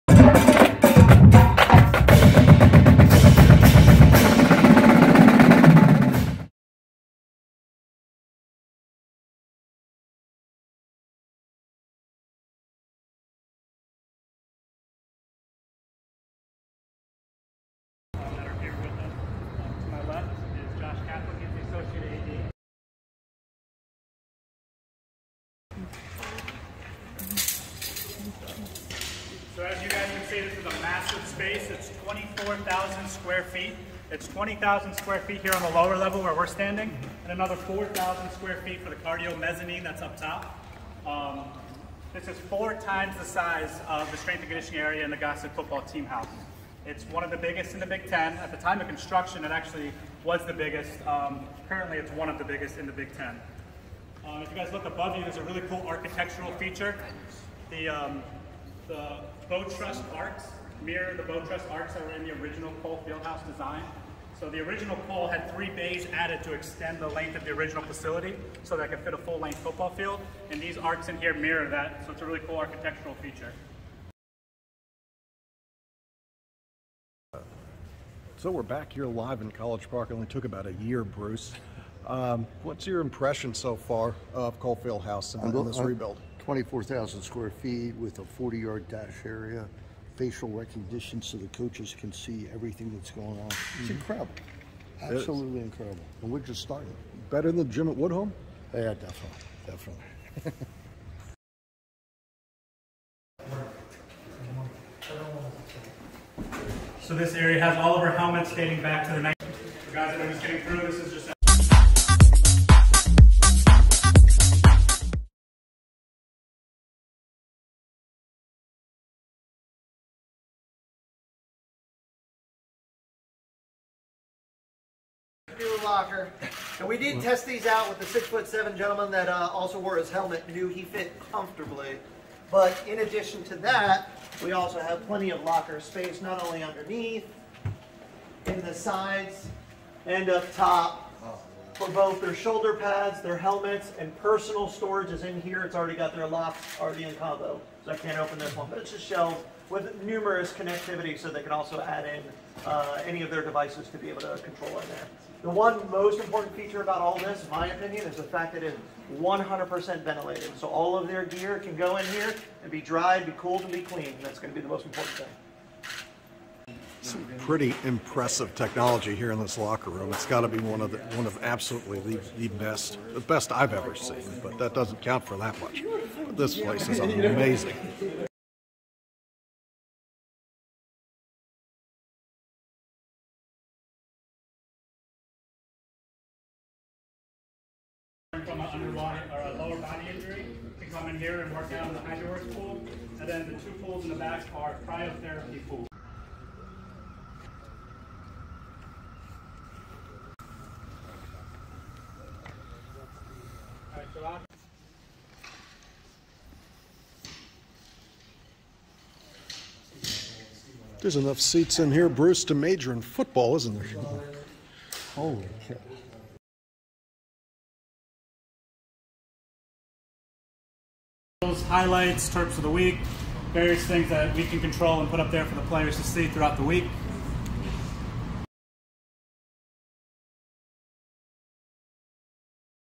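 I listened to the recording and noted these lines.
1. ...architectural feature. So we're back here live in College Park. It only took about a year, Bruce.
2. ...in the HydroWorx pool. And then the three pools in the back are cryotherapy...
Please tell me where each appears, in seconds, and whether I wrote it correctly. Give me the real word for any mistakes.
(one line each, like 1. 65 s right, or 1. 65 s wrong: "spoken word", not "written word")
1. 72 s right
2. 191 s wrong: "two", not "three".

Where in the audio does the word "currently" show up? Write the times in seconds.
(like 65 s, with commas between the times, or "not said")
51 s.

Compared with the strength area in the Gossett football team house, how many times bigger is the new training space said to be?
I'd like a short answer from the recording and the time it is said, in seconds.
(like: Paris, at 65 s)
four times, at 42 s.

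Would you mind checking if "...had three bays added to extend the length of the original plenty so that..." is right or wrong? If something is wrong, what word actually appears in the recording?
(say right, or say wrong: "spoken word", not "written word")
wrong: "facility", not "plenty".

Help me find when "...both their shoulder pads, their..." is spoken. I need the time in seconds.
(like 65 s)
141 s.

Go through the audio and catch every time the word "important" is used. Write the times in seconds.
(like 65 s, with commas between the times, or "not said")
156 s, 164 s.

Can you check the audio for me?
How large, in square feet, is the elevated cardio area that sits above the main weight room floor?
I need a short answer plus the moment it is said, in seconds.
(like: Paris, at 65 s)
4,000 square feet, at 37 s.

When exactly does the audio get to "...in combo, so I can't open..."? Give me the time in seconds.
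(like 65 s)
147 s.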